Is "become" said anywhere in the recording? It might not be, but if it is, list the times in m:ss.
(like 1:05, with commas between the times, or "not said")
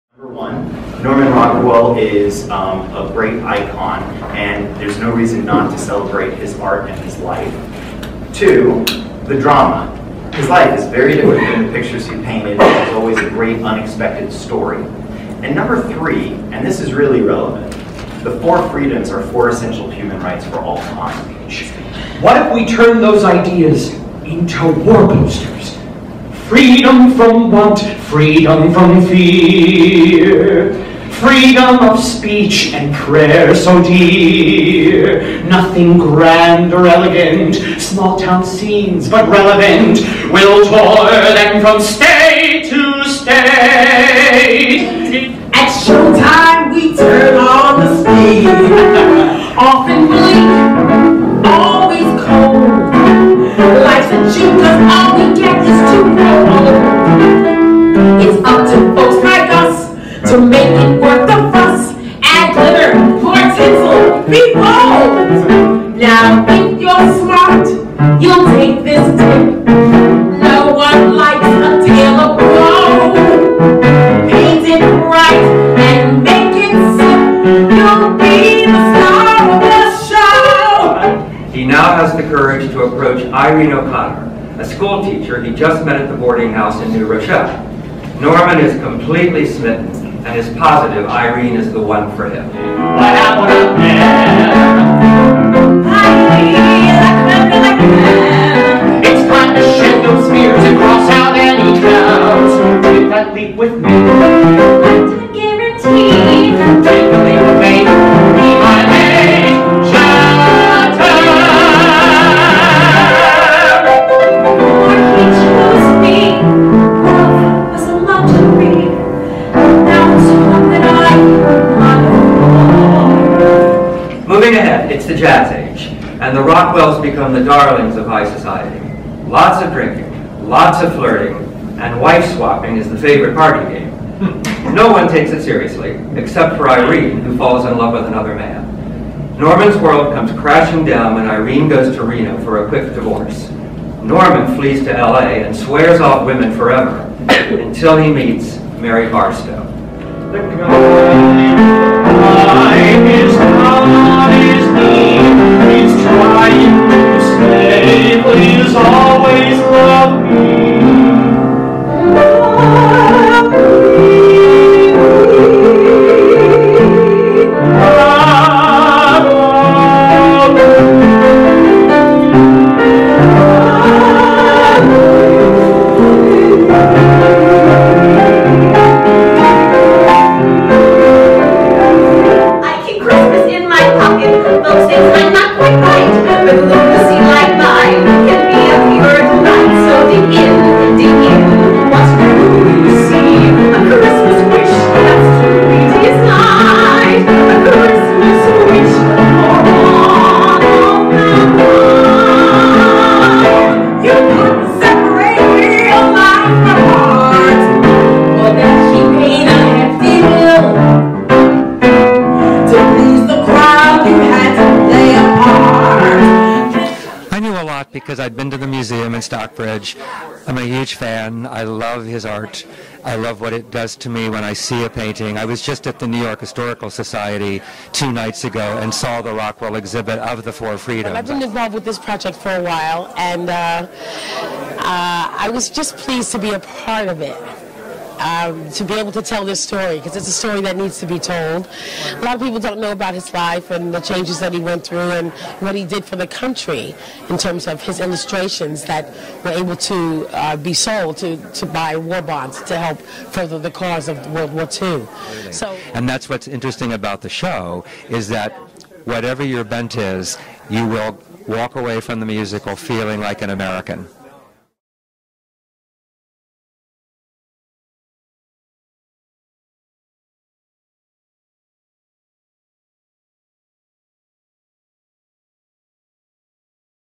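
2:06.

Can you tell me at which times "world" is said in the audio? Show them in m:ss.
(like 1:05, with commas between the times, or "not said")
2:19, 4:14.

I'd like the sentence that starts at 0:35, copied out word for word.
Nothing grand or elegant, small town scenes but relevant, will tour them from state to state.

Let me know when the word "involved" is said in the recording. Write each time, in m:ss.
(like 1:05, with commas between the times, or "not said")
3:51.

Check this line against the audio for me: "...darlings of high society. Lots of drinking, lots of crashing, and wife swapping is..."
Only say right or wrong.
wrong.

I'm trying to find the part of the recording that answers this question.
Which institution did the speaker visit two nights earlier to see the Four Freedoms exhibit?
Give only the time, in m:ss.
3:46.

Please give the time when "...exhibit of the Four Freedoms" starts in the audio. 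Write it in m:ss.
3:49.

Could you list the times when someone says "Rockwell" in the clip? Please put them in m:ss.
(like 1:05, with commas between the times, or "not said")
0:01, 2:06, 3:49.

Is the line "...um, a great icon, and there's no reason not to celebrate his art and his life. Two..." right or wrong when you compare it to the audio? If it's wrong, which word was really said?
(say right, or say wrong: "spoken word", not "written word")
right.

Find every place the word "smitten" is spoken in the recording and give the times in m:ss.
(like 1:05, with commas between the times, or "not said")
1:29.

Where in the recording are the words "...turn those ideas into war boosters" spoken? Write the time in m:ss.
0:22.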